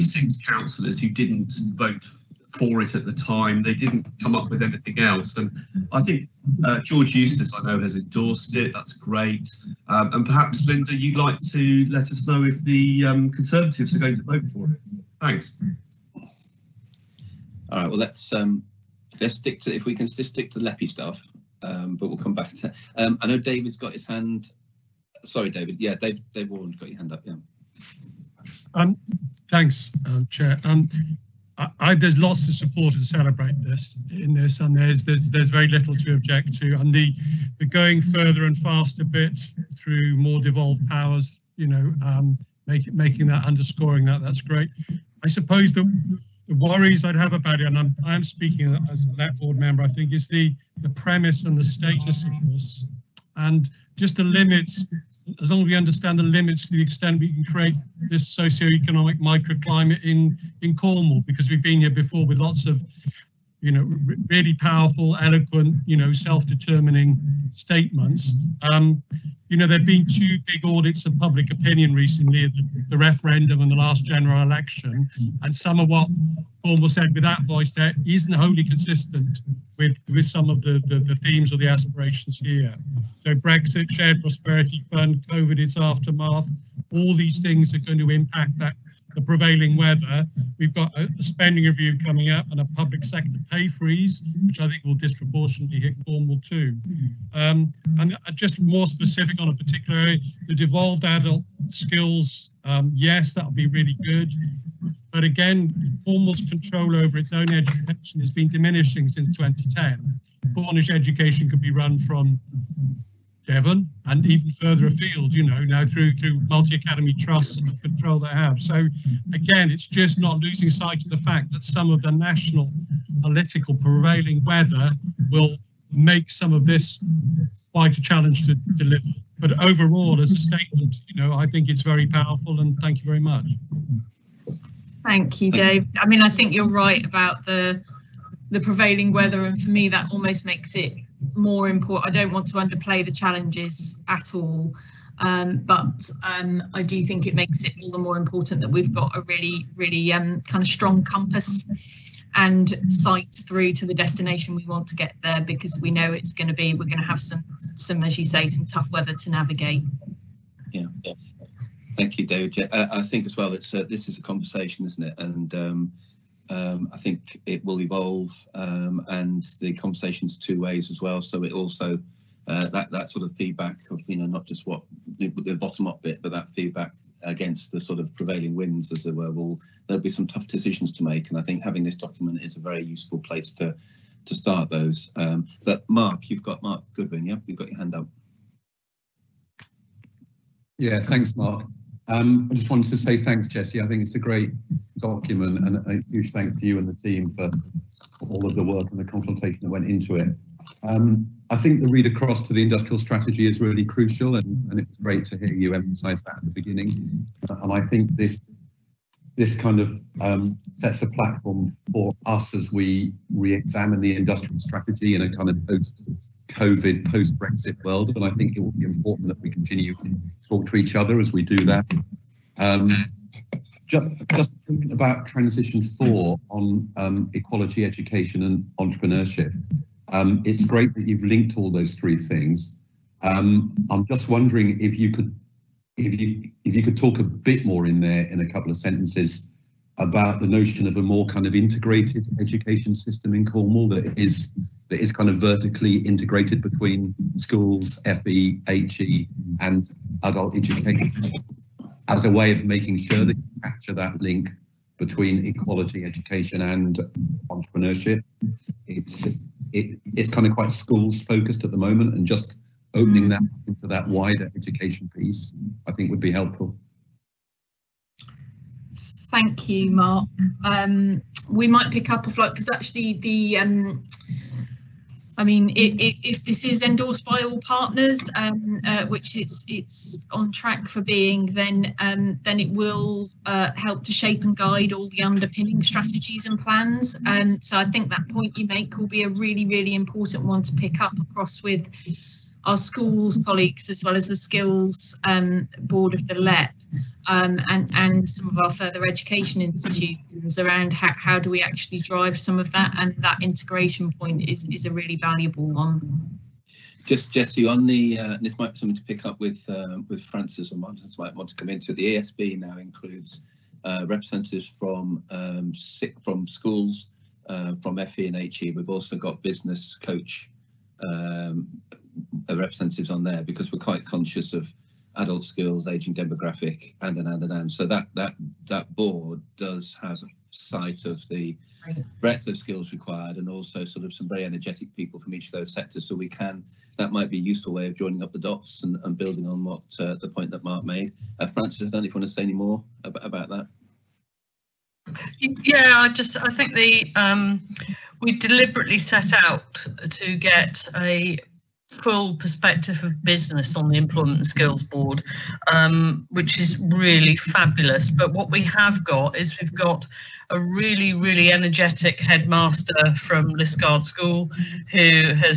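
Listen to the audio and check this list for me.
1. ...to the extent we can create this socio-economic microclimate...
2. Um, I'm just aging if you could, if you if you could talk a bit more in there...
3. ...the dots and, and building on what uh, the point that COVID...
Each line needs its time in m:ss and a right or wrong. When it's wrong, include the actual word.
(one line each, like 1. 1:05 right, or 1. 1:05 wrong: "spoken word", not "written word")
1. 0:56 right
2. 3:53 wrong: "wondering", not "aging"
3. 5:38 wrong: "Mark", not "COVID".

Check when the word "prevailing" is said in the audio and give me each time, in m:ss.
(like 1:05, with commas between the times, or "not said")
1:29, 2:03, 2:18, 2:58.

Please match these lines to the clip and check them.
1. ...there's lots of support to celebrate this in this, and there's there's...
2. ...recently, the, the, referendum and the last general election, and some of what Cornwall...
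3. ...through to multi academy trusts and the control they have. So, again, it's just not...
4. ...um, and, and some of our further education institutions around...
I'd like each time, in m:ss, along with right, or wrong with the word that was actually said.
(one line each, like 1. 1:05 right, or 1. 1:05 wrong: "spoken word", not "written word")
1. 0:31 right
2. 1:11 right
3. 1:55 right
4. 4:57 right.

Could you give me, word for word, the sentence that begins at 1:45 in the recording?
But again, Cornwall's control over its own education has been diminishing since 2010.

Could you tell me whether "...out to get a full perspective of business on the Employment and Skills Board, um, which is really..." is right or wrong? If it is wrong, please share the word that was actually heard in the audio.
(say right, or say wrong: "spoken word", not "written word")
right.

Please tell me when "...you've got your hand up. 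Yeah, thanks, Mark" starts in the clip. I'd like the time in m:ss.
3:07.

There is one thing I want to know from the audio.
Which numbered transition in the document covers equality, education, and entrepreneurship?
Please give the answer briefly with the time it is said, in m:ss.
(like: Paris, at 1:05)
Transition four, at 3:45.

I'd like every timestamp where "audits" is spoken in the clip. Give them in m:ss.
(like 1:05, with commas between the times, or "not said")
1:10.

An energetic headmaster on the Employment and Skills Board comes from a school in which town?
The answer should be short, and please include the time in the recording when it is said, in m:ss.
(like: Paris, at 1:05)
Liskeard, at 6:03.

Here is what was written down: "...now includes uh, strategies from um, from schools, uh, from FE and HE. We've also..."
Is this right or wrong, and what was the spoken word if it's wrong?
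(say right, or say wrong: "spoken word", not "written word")
wrong: "representatives", not "strategies".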